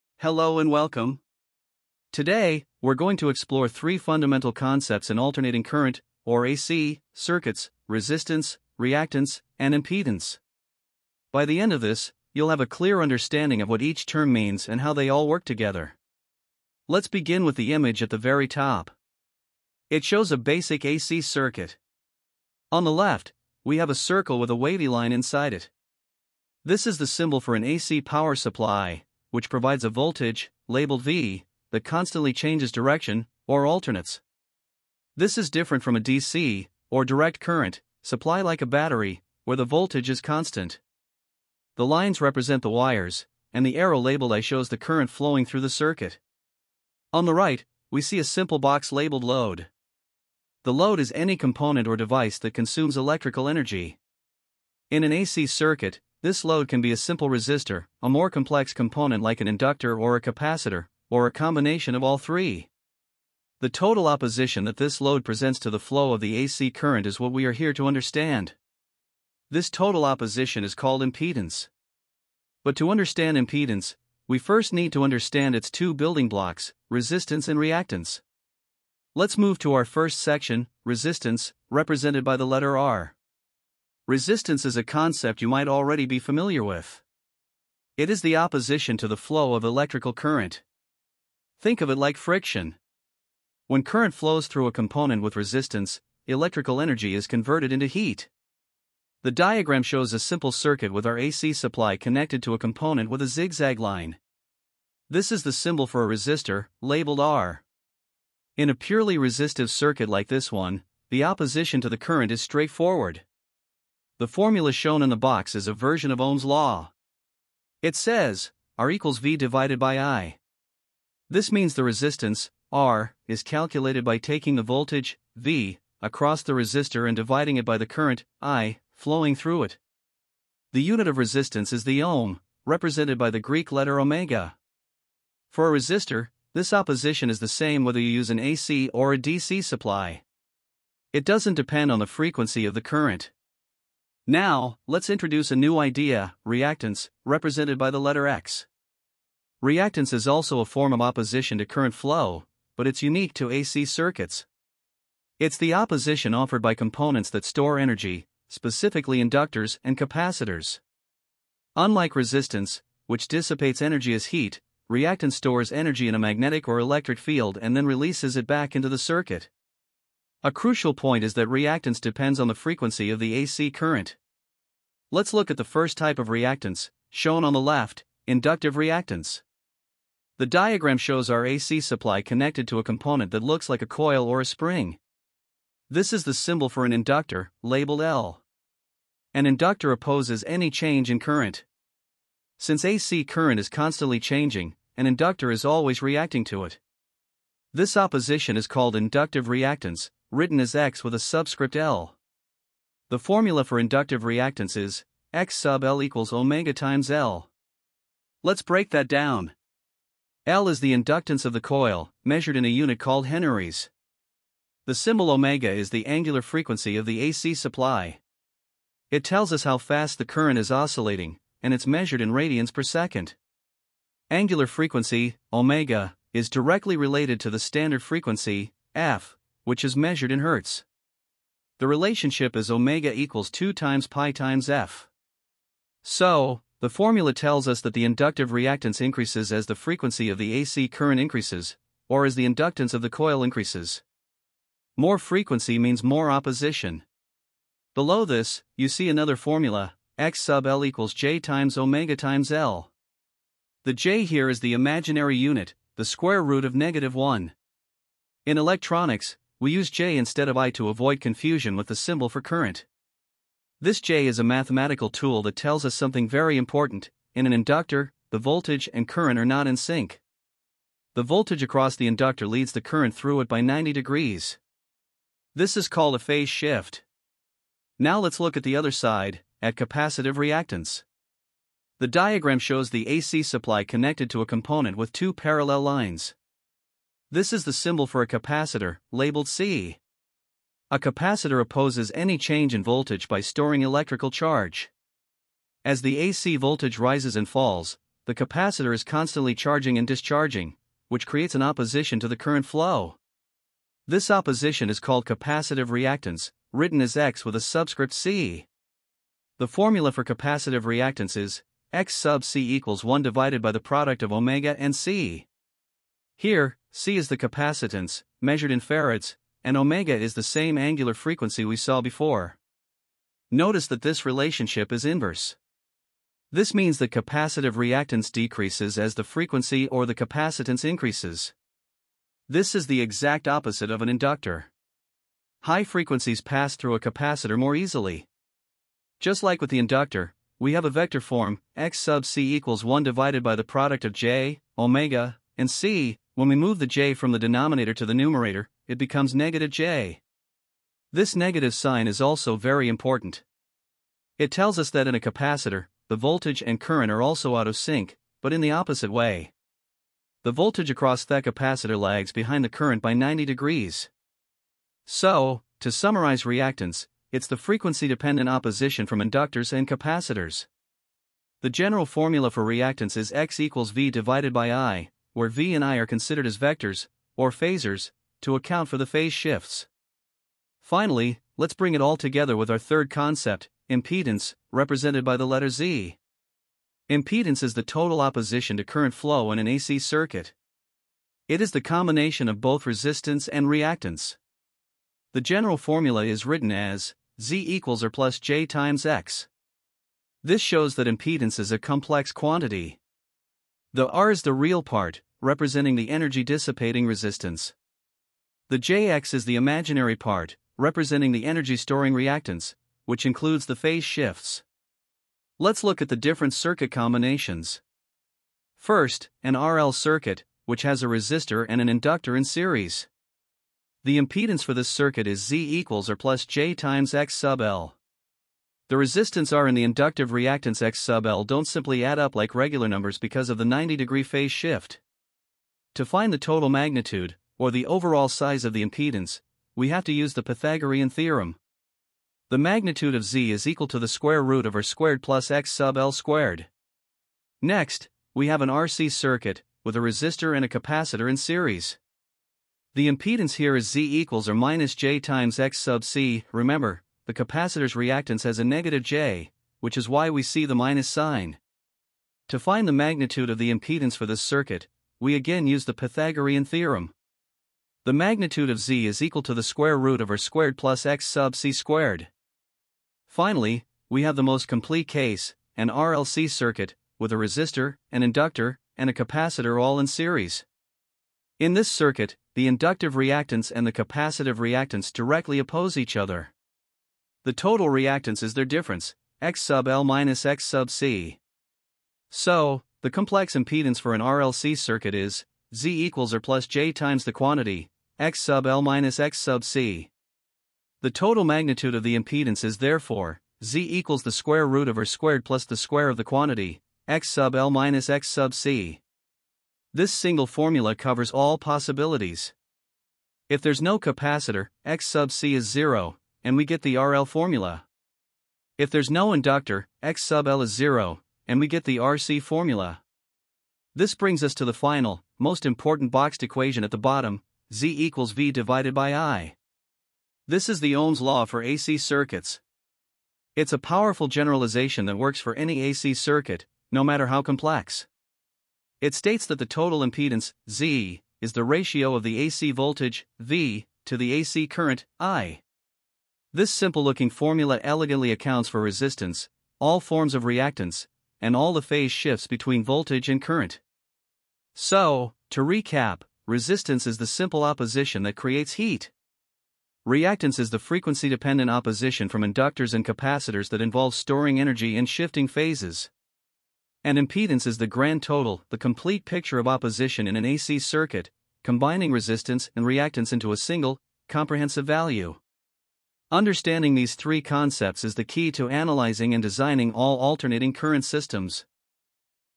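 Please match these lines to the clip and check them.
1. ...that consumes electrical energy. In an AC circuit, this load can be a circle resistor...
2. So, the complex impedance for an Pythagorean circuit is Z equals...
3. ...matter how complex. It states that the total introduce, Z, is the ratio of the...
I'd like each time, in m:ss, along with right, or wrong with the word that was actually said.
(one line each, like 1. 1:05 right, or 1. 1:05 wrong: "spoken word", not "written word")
1. 0:52 wrong: "simple", not "circle"
2. 8:12 wrong: "RLC", not "Pythagorean"
3. 8:57 wrong: "impedance", not "introduce".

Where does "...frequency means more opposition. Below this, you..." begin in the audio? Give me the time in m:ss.
4:05.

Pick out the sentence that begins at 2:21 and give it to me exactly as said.
It doesn't depend on the frequency of the current.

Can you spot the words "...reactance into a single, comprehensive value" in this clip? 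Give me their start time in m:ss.
9:32.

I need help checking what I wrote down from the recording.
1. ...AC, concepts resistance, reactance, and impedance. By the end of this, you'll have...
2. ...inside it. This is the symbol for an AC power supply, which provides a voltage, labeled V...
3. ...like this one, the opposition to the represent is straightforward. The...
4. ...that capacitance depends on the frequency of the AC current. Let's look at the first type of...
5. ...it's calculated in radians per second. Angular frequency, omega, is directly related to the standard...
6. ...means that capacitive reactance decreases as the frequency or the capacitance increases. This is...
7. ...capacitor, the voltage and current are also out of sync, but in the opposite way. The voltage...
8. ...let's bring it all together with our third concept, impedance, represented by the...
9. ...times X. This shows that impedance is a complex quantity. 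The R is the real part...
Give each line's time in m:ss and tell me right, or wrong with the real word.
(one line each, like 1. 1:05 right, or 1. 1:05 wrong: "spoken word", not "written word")
1. 0:06 wrong: "circuits", not "concepts"
2. 0:25 right
3. 1:50 wrong: "current", not "represent"
4. 2:51 wrong: "reactance", not "capacitance"
5. 3:41 wrong: "measured", not "calculated"
6. 5:26 right
7. 5:55 right
8. 6:21 right
9. 6:38 right.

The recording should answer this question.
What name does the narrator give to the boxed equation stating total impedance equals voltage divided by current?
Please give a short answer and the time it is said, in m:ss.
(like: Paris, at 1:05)
Ohm's law for AC circuits, at 8:50.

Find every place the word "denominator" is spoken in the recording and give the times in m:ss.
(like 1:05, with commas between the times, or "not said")
5:47.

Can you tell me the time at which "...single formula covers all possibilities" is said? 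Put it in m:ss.
8:30.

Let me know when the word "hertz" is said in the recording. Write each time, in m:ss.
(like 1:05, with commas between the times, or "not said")
3:50.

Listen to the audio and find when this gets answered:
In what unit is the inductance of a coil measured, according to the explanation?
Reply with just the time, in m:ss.
3:33.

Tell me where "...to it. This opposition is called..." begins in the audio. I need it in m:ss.
3:16.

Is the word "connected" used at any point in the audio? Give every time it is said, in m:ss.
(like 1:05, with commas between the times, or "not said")
1:41, 3:02, 4:43.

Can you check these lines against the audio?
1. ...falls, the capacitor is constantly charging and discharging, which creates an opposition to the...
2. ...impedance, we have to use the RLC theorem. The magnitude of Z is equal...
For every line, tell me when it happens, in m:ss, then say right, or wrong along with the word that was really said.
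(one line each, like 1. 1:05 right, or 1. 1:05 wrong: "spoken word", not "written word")
1. 4:57 right
2. 7:18 wrong: "Pythagorean", not "RLC".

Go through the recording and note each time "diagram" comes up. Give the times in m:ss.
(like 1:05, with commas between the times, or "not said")
1:39, 3:00, 4:42.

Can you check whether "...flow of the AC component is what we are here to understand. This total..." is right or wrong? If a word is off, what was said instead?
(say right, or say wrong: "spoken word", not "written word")
wrong: "current", not "component".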